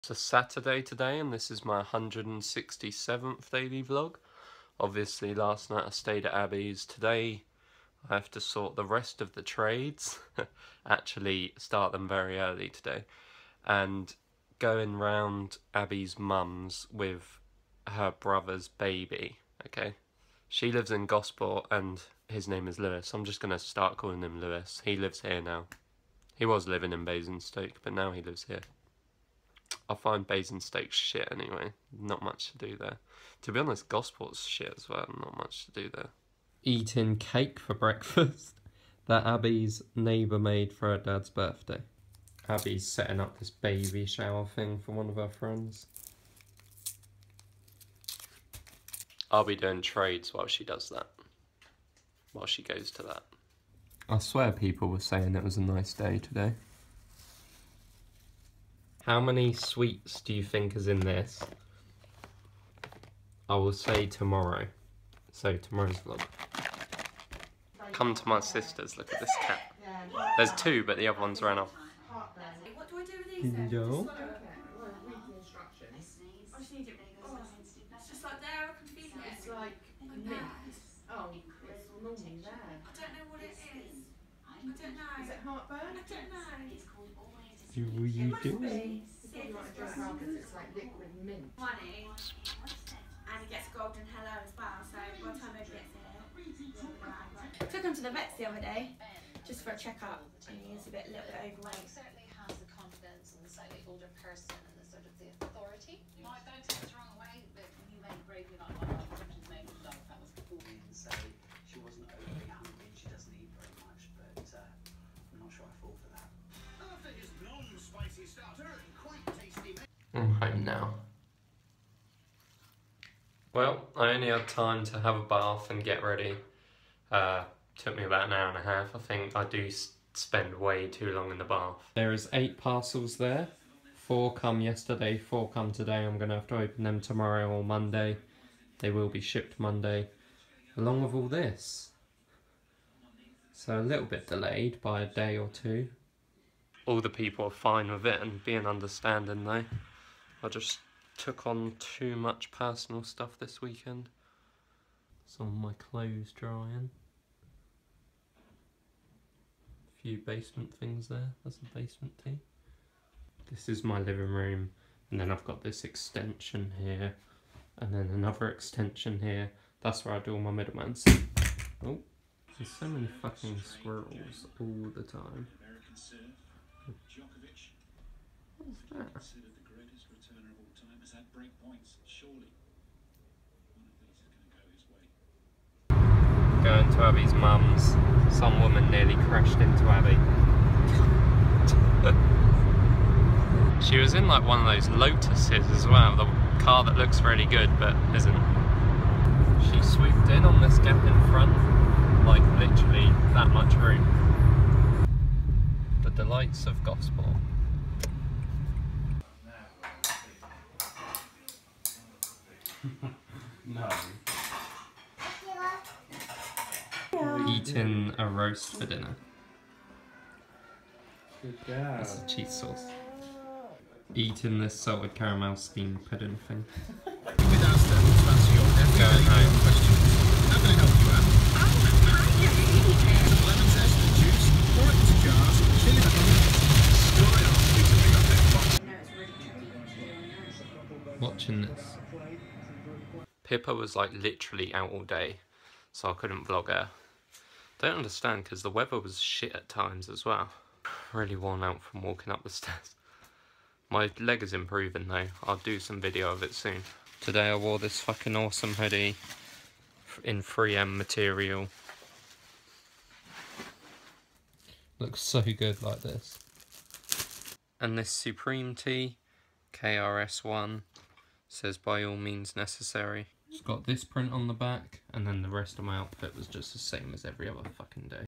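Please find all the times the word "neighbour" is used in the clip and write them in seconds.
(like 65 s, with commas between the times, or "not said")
39 s.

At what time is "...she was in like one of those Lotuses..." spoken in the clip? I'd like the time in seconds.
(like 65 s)
193 s.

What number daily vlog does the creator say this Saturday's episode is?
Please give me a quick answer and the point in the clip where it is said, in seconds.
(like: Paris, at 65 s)
167, at 1 s.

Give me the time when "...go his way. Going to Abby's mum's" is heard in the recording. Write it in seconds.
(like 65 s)
185 s.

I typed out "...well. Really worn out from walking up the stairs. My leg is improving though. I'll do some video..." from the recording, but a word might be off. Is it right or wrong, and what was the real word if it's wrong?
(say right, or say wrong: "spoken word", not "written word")
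right.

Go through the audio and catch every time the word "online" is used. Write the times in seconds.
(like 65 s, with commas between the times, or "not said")
not said.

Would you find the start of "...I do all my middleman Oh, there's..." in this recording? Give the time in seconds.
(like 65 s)
170 s.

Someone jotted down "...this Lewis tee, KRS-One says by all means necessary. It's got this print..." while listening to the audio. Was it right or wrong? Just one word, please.
wrong.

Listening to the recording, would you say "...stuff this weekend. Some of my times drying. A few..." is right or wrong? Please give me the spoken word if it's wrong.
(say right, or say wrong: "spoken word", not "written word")
wrong: "clothes", not "times".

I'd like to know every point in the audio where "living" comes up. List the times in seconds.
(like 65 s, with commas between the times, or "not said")
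26 s, 163 s.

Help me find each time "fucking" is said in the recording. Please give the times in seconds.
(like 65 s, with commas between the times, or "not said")
173 s, 257 s, 277 s.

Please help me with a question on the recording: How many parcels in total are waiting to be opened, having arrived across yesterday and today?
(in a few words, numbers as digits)
8.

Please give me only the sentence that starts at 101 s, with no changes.
certainly has the confidence and the slightly older person.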